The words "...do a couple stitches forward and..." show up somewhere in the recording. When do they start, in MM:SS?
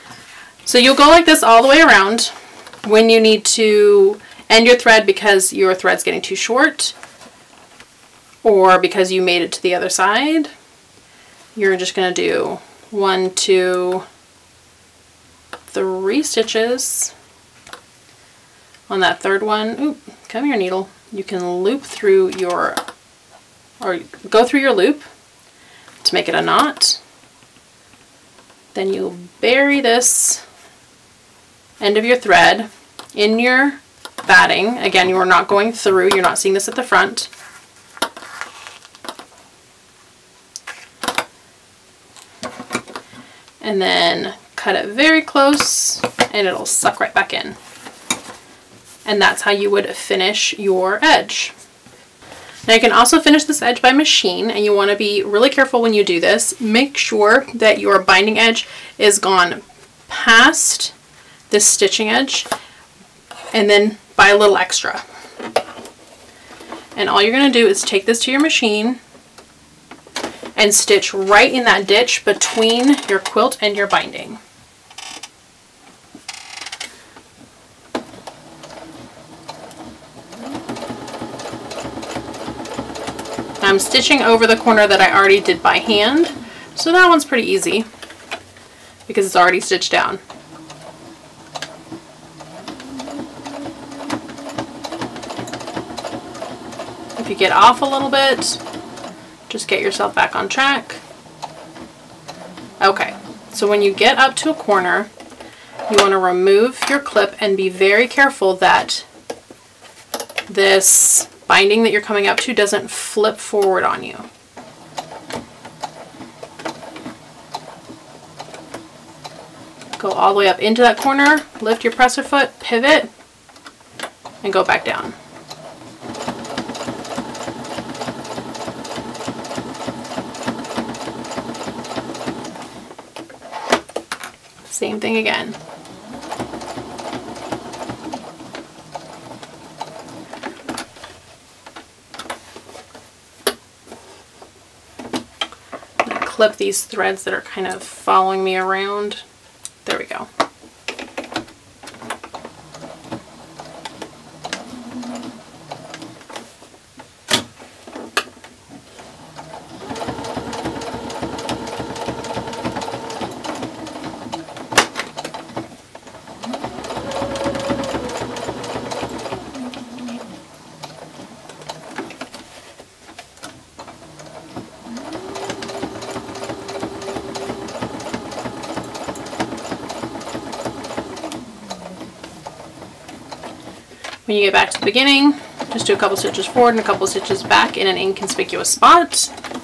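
03:05.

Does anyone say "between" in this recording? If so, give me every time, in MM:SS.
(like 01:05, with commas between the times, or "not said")
01:12.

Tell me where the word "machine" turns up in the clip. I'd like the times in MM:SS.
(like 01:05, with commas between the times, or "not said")
00:53, 01:08.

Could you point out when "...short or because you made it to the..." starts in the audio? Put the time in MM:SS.
00:06.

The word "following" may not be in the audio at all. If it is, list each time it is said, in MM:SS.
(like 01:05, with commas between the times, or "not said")
02:27.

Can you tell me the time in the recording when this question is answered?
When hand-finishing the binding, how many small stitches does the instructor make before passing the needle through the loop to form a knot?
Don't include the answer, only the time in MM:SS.
00:12.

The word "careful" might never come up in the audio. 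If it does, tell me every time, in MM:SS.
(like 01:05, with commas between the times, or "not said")
00:55, 01:48.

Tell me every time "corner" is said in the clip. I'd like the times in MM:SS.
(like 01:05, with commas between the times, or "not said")
01:24, 01:44, 02:00.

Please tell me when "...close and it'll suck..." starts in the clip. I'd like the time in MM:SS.
00:45.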